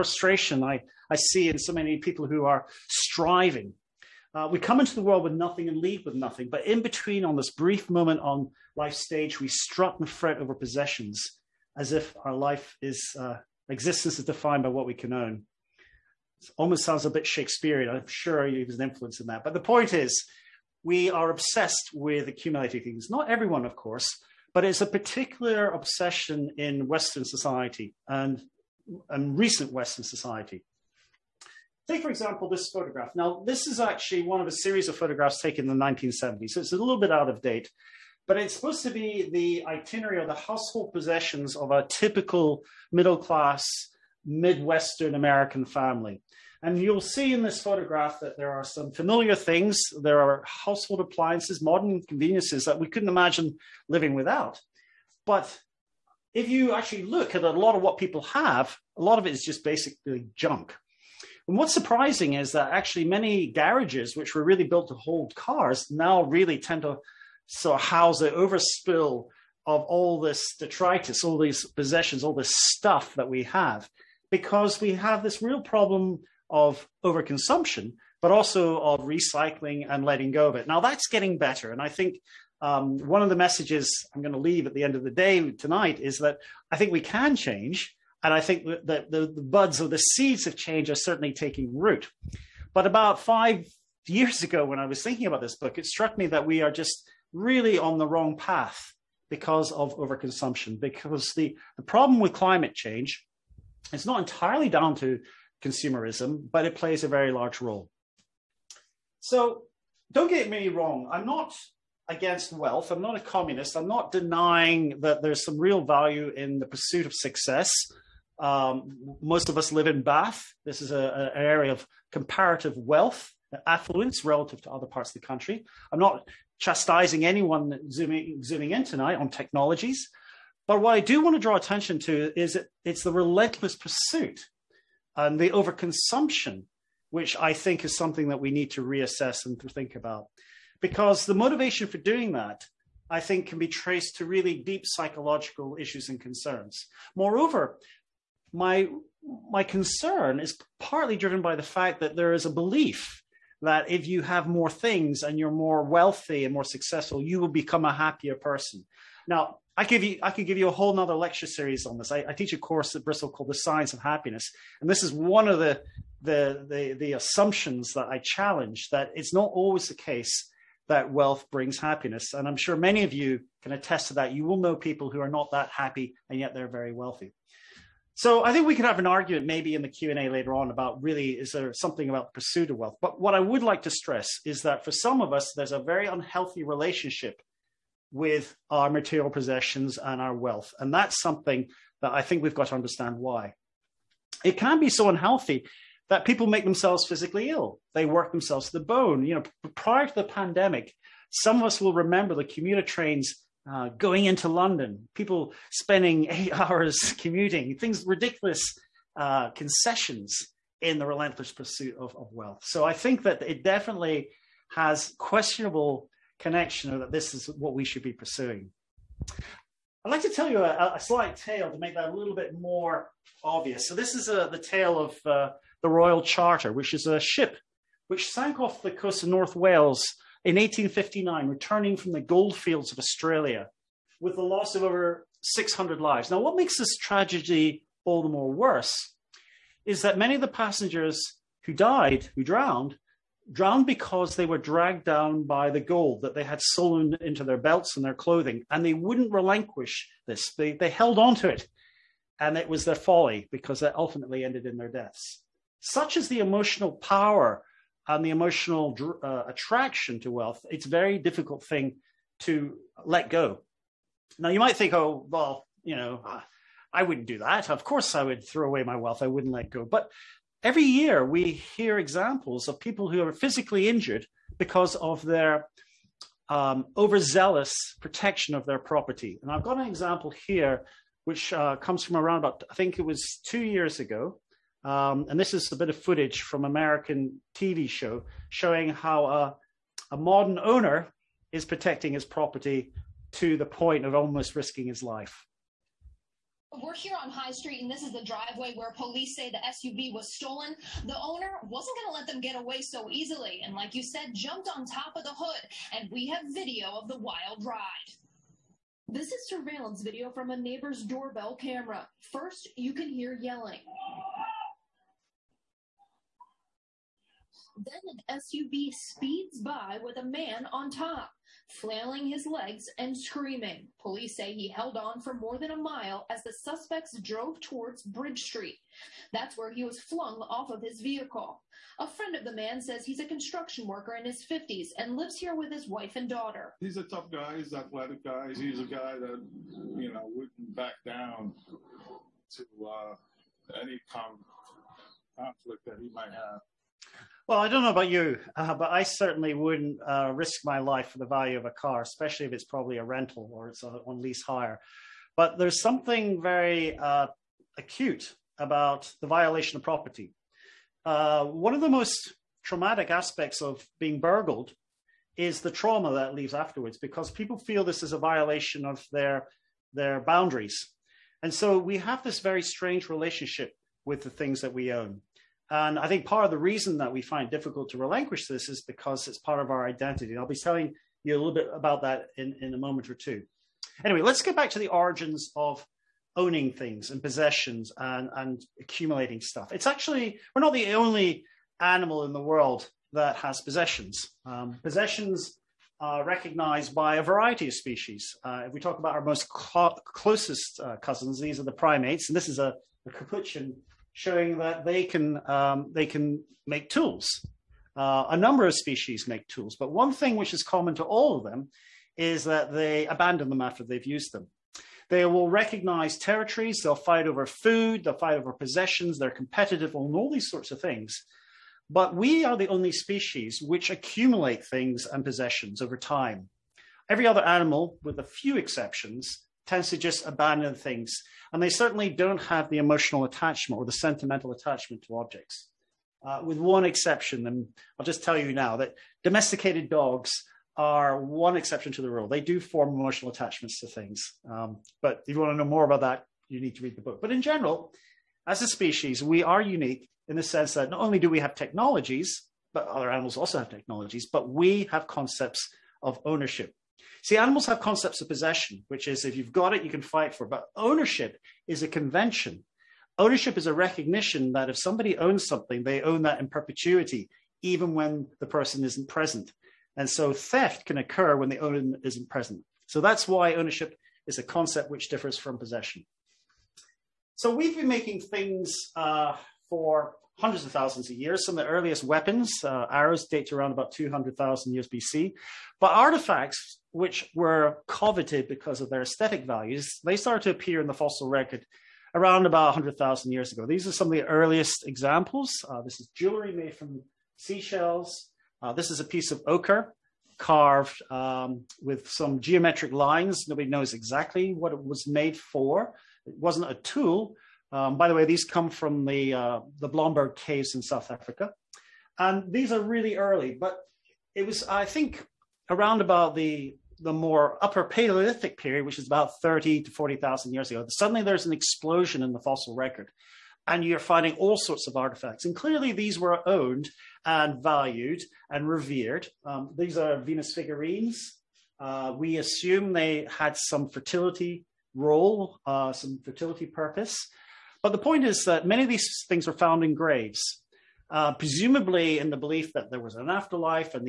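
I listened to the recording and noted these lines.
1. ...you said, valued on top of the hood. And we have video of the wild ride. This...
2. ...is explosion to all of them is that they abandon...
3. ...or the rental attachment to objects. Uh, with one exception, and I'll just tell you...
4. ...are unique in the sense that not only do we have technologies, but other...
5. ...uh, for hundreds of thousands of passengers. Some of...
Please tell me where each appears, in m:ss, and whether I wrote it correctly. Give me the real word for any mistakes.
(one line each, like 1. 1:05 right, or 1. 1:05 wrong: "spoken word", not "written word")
1. 5:03 wrong: "jumped", not "valued"
2. 6:50 wrong: "common", not "explosion"
3. 7:13 wrong: "sentimental", not "rental"
4. 7:29 right
5. 7:58 wrong: "years", not "passengers".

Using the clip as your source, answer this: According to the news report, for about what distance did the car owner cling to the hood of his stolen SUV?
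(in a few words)
more than a mile.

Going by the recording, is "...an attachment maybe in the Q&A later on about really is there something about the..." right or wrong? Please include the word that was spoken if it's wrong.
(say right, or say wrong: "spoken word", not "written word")
wrong: "argument", not "attachment".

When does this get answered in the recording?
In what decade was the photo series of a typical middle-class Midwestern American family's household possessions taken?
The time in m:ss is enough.
0:35.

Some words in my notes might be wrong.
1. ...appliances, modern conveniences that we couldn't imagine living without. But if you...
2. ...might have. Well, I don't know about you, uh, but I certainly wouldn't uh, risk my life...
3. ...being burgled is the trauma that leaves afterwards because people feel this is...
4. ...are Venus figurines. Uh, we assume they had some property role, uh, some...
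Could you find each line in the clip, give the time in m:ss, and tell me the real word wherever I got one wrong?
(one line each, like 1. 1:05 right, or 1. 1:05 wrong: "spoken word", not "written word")
1. 0:51 right
2. 5:46 right
3. 6:03 right
4. 8:49 wrong: "fertility", not "property".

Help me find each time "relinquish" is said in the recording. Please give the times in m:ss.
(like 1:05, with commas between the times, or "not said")
4:09, 6:17.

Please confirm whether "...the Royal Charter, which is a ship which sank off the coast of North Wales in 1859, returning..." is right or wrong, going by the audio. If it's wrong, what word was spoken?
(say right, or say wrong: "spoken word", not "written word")
right.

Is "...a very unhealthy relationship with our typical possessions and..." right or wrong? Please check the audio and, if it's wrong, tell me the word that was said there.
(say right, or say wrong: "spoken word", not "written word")
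wrong: "material", not "typical".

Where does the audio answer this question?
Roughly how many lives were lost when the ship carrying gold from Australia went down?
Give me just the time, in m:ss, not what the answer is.
3:54.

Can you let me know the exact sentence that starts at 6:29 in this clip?
It's actually, we're not the only animal in the world that has possessions.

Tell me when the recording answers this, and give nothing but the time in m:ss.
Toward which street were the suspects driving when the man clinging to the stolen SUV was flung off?
5:28.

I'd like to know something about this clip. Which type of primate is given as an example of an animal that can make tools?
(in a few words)
Capuchin.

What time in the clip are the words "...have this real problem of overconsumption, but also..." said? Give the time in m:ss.
1:14.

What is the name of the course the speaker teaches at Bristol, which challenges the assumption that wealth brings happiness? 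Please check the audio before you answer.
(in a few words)
The Science of Happiness.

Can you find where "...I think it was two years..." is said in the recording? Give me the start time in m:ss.
4:42.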